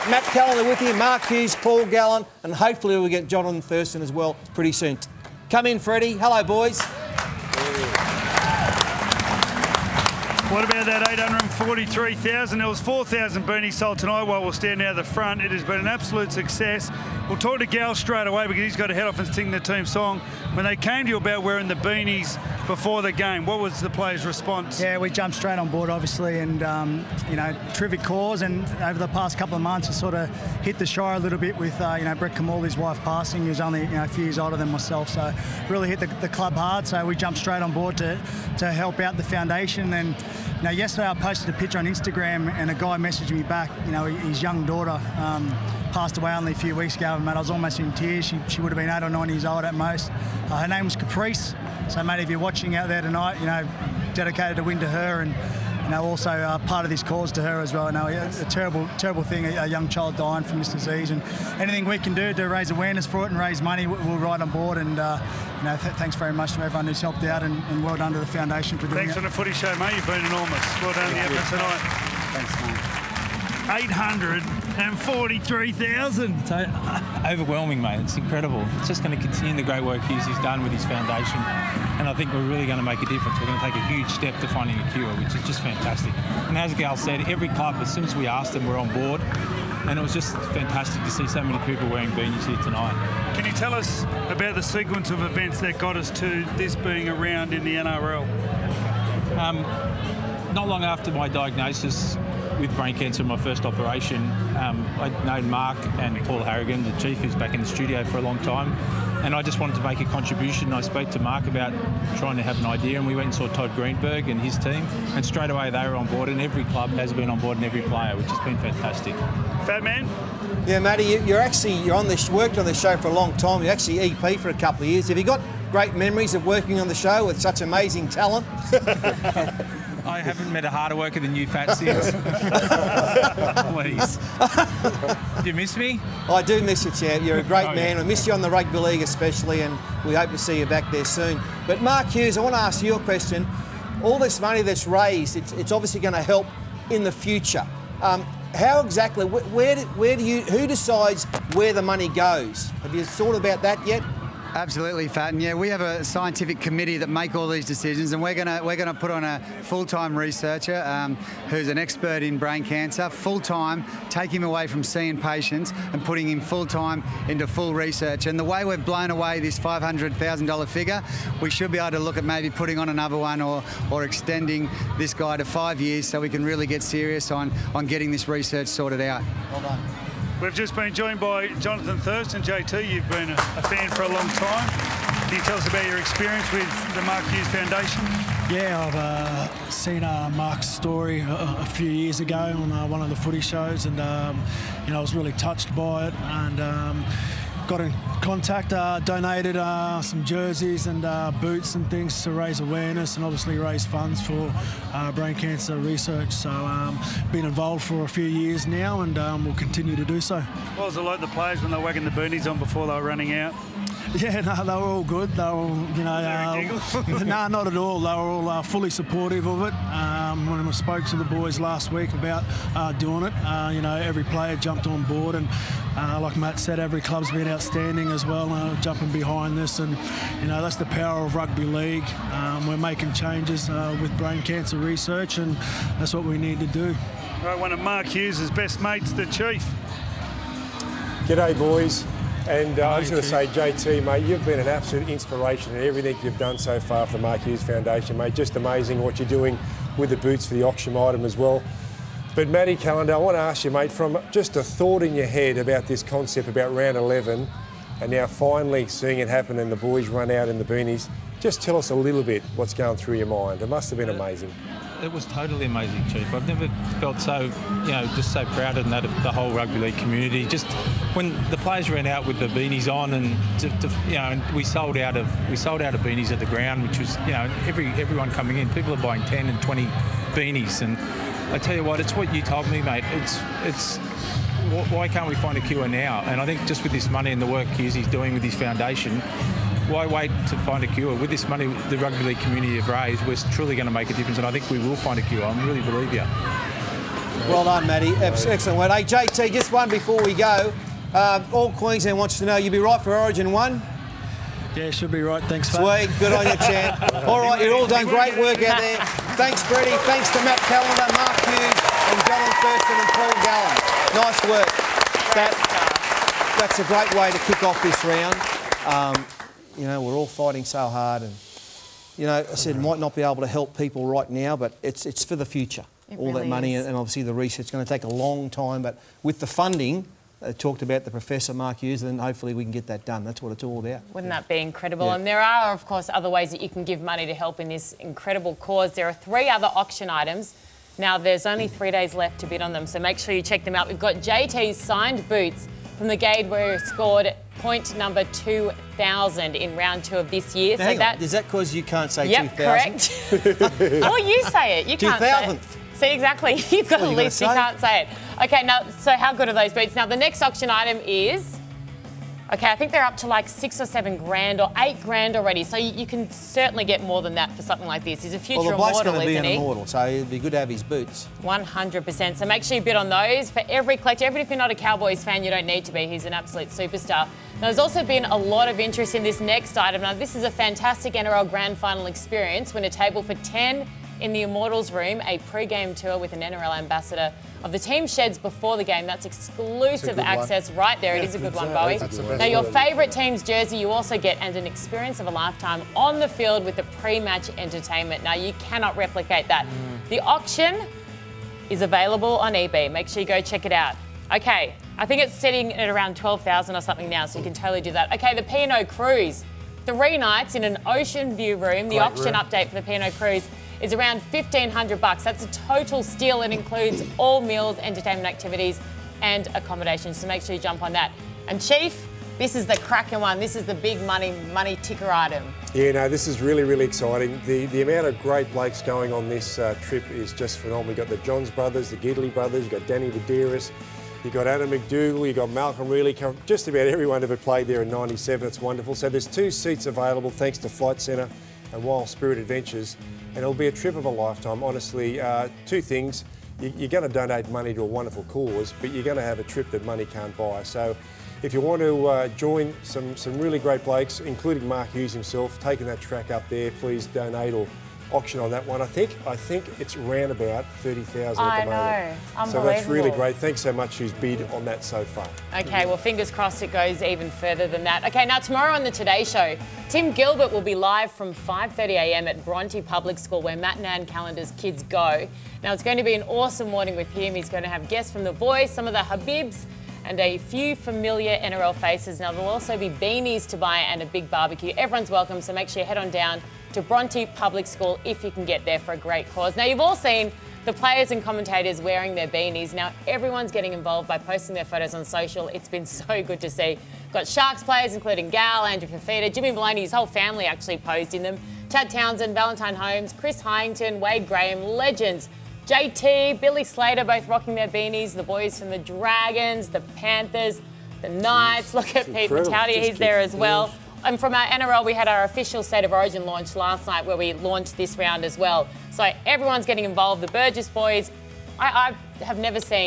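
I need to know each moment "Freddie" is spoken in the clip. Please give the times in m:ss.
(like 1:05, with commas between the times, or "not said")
0:05, 5:09.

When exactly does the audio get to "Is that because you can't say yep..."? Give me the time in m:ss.
5:51.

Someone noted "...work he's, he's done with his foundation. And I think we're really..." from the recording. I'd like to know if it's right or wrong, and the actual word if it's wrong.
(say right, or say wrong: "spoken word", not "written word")
right.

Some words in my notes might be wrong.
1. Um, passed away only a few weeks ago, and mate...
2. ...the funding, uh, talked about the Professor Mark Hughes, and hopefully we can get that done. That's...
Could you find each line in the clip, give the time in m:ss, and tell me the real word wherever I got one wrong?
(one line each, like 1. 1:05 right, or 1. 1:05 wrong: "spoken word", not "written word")
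1. 0:45 right
2. 5:29 right.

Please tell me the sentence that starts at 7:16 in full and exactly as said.
Just about everyone ever played there in 97.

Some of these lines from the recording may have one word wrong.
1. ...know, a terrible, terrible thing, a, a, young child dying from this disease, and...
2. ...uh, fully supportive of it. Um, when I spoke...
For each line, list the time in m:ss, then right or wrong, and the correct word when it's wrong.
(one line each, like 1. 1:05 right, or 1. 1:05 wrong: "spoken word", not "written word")
1. 0:57 right
2. 3:38 right.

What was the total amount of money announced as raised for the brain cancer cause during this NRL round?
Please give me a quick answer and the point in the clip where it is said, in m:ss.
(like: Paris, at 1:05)
843,000, at 0:11.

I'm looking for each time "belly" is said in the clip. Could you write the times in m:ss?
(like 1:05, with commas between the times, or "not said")
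not said.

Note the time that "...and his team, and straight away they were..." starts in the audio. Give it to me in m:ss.
1:54.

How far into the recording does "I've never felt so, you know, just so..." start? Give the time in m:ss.
4:26.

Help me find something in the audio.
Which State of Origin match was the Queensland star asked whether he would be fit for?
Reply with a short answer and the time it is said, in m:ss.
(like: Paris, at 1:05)
Origin 1, at 5:03.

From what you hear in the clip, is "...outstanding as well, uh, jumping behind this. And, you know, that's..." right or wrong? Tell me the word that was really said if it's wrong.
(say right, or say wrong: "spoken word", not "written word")
right.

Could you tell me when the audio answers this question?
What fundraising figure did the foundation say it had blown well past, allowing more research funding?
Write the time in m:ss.
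2:49.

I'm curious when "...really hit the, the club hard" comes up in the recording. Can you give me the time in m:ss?
0:35.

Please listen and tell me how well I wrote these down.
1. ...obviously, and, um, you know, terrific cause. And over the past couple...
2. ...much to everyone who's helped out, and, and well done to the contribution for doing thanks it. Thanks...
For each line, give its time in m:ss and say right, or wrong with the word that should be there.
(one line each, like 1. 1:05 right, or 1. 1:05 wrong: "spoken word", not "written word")
1. 0:25 right
2. 1:06 wrong: "foundation", not "contribution".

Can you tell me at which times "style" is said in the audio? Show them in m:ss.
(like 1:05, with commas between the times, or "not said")
not said.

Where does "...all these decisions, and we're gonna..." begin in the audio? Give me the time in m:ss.
2:37.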